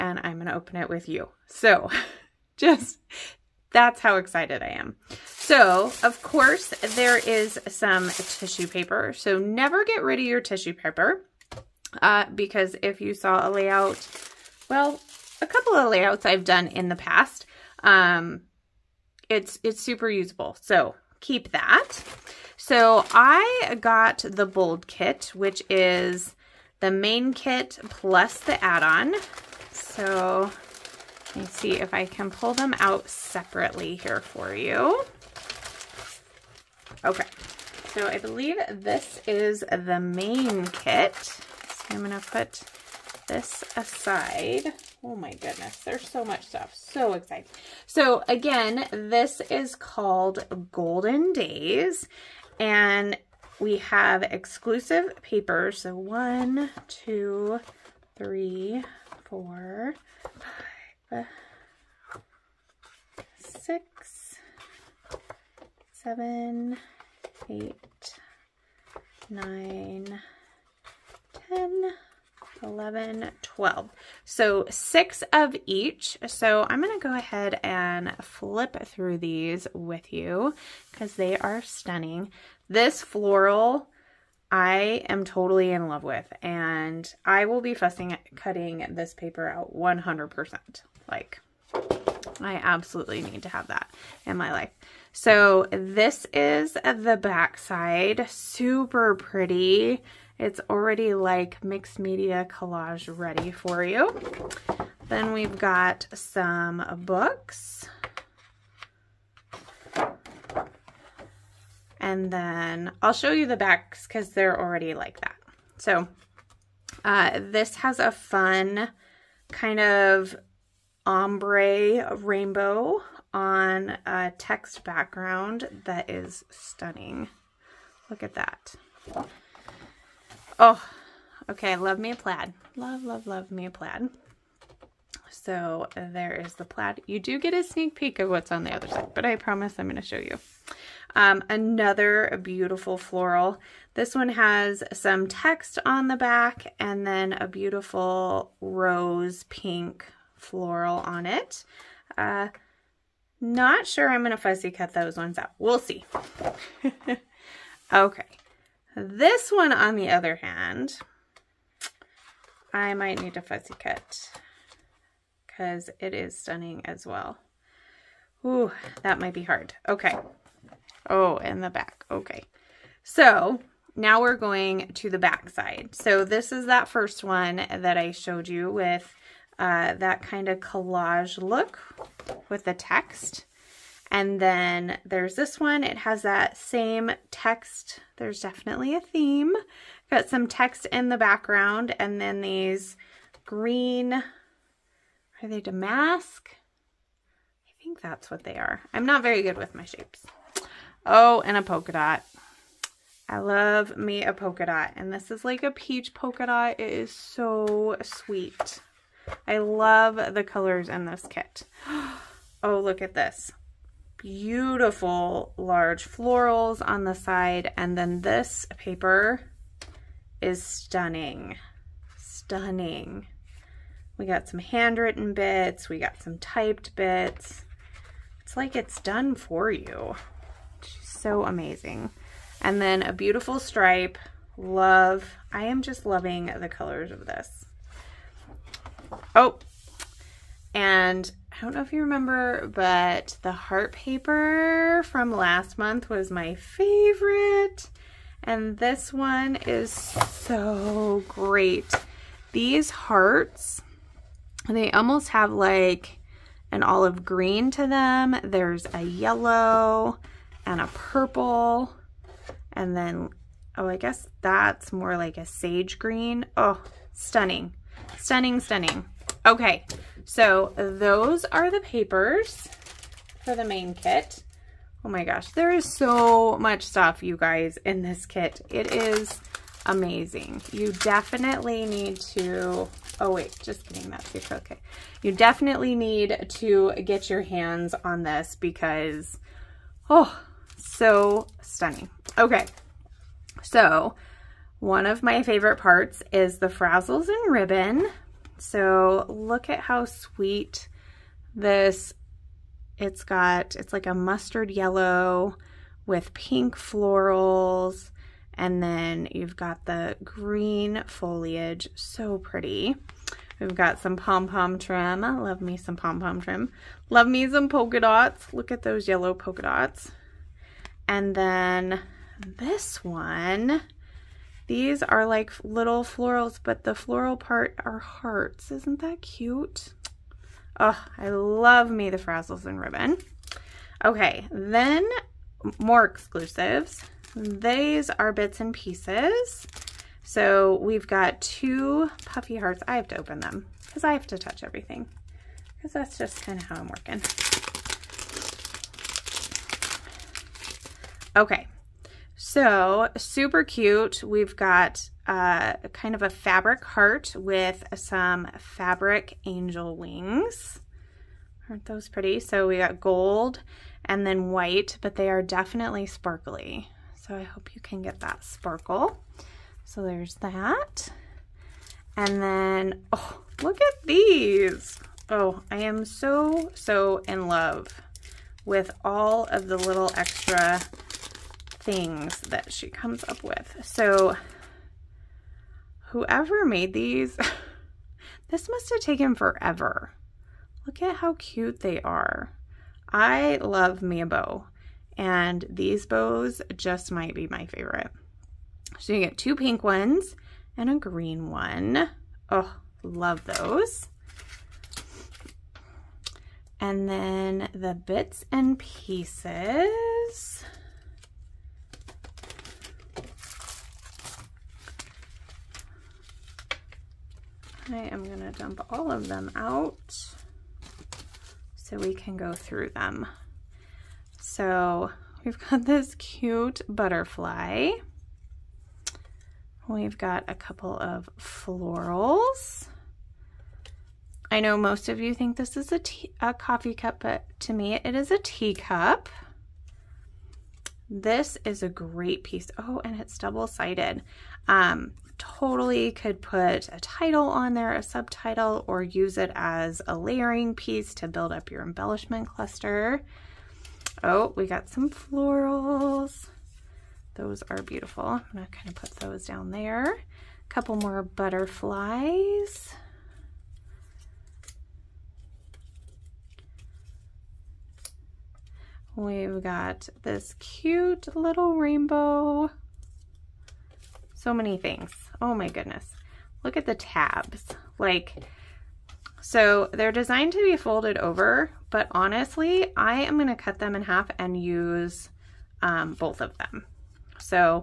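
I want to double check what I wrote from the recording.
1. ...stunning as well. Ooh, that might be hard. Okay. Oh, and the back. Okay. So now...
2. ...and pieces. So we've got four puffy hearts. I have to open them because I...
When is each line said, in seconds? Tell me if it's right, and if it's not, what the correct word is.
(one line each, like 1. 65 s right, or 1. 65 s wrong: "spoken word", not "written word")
1. 166 s right
2. 338 s wrong: "two", not "four".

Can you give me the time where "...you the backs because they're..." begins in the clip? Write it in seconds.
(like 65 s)
113 s.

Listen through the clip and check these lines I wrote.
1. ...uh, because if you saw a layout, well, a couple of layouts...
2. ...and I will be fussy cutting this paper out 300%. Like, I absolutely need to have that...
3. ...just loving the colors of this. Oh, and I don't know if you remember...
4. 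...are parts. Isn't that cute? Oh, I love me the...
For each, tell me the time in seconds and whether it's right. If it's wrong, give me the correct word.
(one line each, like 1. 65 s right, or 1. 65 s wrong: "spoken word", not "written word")
1. 12 s right
2. 86 s wrong: "100", not "300"
3. 235 s right
4. 327 s wrong: "hearts", not "parts".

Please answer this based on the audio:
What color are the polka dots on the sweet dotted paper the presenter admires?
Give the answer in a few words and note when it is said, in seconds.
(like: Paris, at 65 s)
peach, at 205 s.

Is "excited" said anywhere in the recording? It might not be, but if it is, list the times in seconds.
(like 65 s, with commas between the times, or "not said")
4 s, 47 s.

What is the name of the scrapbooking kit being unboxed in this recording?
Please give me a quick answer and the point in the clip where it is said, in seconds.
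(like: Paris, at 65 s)
Golden Days, at 50 s.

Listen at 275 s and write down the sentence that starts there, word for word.
Oh my gosh, there is so much stuff, you guys, in this kit.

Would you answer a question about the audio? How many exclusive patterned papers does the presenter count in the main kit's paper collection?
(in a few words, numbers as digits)
12.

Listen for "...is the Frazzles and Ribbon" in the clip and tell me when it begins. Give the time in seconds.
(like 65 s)
296 s.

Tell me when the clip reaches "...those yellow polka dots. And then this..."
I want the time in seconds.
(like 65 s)
318 s.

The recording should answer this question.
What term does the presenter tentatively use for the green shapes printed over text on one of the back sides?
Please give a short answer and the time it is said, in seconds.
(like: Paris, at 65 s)
damask, at 195 s.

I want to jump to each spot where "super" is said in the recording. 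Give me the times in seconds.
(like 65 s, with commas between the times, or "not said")
19 s, 98 s, 353 s.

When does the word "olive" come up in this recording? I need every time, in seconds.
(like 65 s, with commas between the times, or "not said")
256 s.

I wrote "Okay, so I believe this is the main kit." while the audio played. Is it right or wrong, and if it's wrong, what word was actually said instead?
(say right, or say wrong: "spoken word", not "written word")
right.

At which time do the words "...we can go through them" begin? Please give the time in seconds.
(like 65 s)
421 s.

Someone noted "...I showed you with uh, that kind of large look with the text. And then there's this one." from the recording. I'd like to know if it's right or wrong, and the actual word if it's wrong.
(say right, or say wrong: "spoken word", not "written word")
wrong: "collage", not "large".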